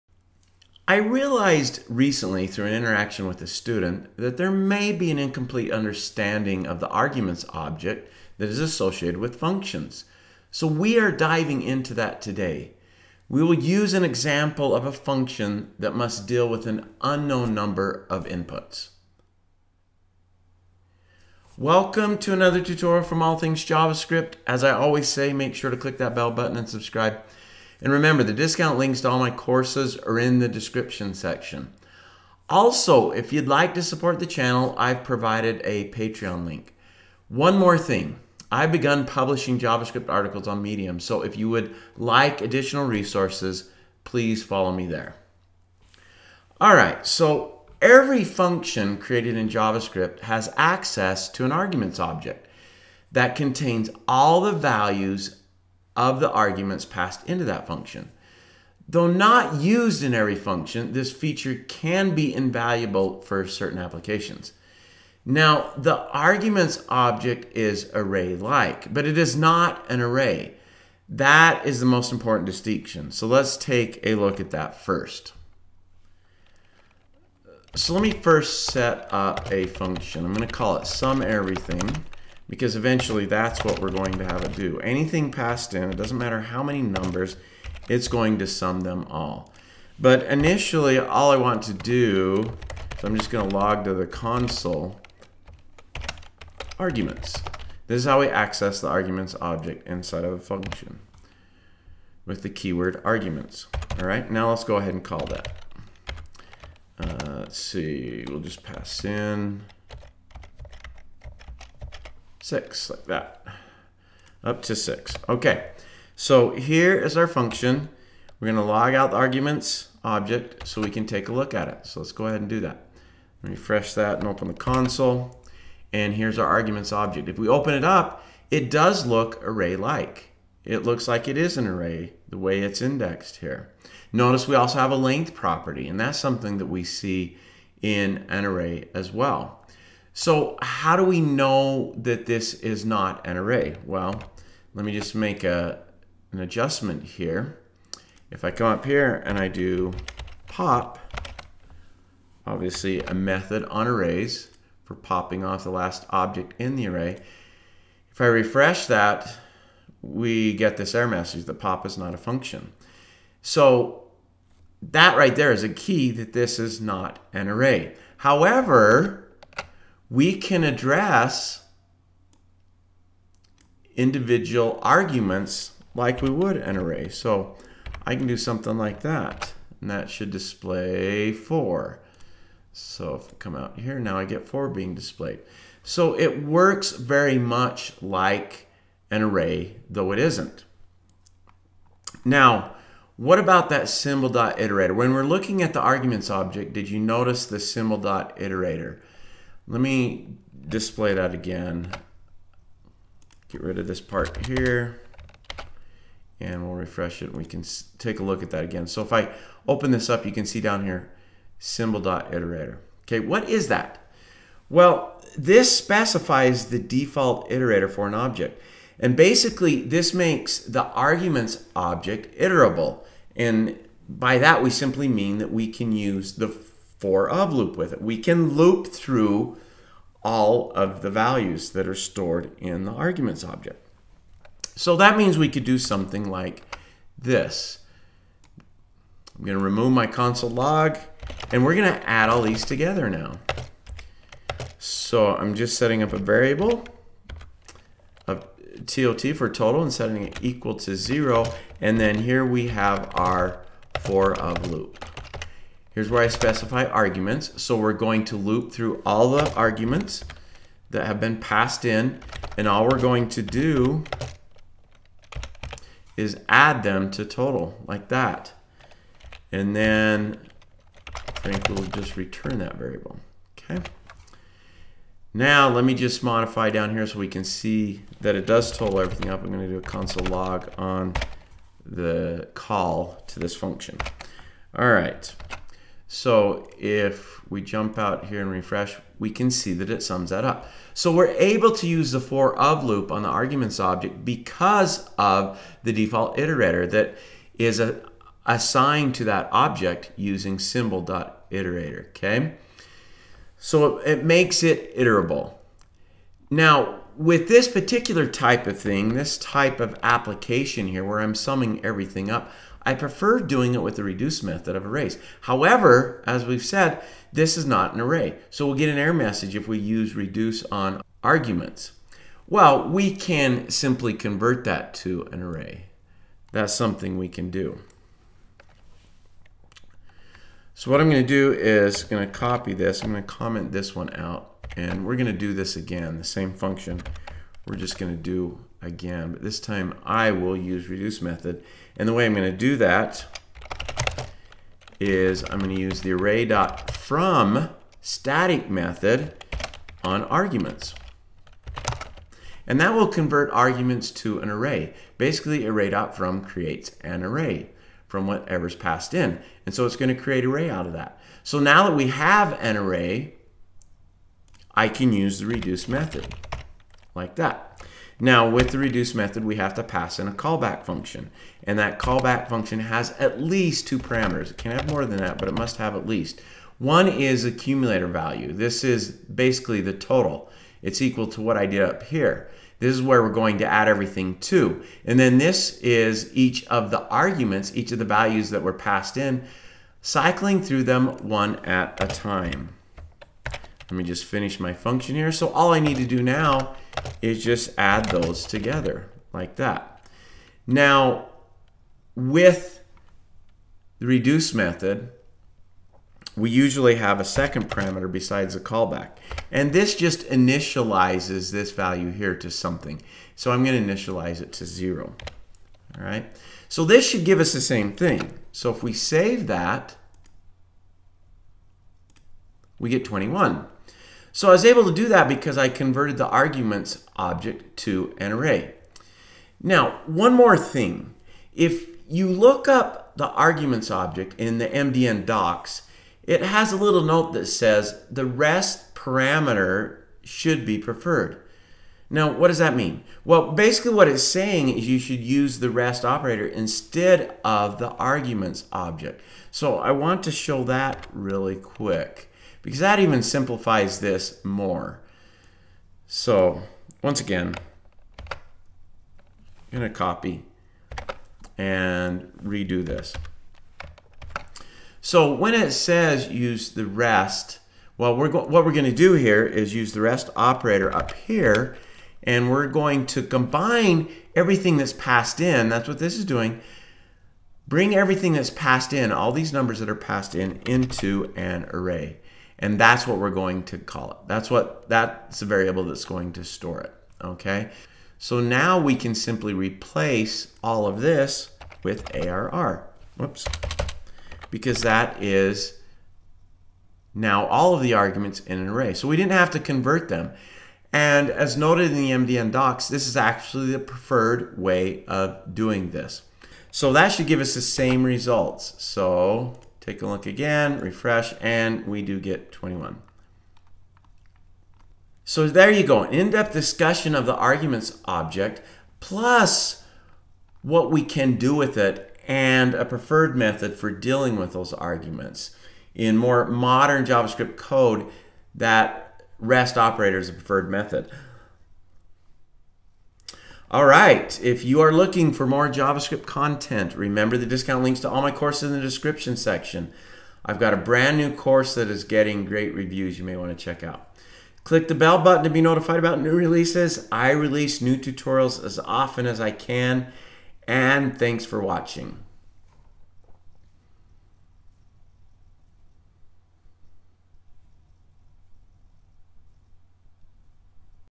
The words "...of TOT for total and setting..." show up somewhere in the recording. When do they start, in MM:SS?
04:08.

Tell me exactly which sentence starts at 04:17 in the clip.
So we're going to loop through all the arguments that have been passed in.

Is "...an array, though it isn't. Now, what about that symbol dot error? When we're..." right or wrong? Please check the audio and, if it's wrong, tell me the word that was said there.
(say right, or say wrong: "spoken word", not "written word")
wrong: "iterator", not "error".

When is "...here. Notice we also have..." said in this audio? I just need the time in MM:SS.
02:13.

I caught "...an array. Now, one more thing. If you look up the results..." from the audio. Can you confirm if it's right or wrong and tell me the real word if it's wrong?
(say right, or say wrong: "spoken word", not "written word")
wrong: "arguments", not "results".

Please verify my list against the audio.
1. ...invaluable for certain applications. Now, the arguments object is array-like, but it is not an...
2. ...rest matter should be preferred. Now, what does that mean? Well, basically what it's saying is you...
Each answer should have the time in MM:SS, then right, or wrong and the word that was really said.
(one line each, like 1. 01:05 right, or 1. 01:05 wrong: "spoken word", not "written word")
1. 01:02 right
2. 07:18 wrong: "parameter", not "matter".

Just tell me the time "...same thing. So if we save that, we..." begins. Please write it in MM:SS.
06:57.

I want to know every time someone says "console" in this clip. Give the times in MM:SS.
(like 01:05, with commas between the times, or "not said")
01:34, 02:04, 04:00, 04:39.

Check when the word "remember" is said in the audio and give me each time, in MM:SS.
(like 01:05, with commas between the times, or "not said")
00:27, 08:56.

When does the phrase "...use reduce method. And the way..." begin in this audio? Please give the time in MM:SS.
05:40.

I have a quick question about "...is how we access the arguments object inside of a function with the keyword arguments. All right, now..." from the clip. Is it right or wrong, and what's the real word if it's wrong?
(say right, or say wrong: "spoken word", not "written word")
right.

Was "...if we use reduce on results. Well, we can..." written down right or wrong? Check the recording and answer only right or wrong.
wrong.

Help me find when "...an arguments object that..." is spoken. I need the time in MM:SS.
00:51.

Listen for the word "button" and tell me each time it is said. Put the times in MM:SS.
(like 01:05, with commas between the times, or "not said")
00:26, 09:05.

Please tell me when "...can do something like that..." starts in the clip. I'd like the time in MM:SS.
02:58.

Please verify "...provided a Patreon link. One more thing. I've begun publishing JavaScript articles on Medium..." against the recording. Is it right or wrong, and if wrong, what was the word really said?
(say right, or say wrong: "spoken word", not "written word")
right.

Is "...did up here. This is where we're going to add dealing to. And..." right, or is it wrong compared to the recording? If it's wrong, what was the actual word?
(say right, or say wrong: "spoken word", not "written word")
wrong: "everything", not "dealing".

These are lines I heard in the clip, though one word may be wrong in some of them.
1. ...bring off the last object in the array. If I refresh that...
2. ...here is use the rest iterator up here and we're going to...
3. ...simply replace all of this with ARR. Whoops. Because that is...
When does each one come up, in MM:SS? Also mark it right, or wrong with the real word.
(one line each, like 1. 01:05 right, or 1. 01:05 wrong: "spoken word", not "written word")
1. 02:34 wrong: "popping", not "bring"
2. 07:49 wrong: "operator", not "iterator"
3. 08:09 right.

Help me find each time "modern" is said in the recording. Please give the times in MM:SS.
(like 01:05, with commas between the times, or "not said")
08:46.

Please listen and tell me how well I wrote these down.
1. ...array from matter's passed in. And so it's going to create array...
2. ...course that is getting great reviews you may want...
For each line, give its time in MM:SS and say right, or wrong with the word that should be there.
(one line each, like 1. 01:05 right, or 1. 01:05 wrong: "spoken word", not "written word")
1. 05:57 wrong: "whatever", not "matter"
2. 09:01 right.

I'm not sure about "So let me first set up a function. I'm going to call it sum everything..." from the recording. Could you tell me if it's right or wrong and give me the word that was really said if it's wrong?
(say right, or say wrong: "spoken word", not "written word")
right.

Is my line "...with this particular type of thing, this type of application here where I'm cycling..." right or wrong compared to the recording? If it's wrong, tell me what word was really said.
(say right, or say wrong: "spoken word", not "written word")
wrong: "summing", not "cycling".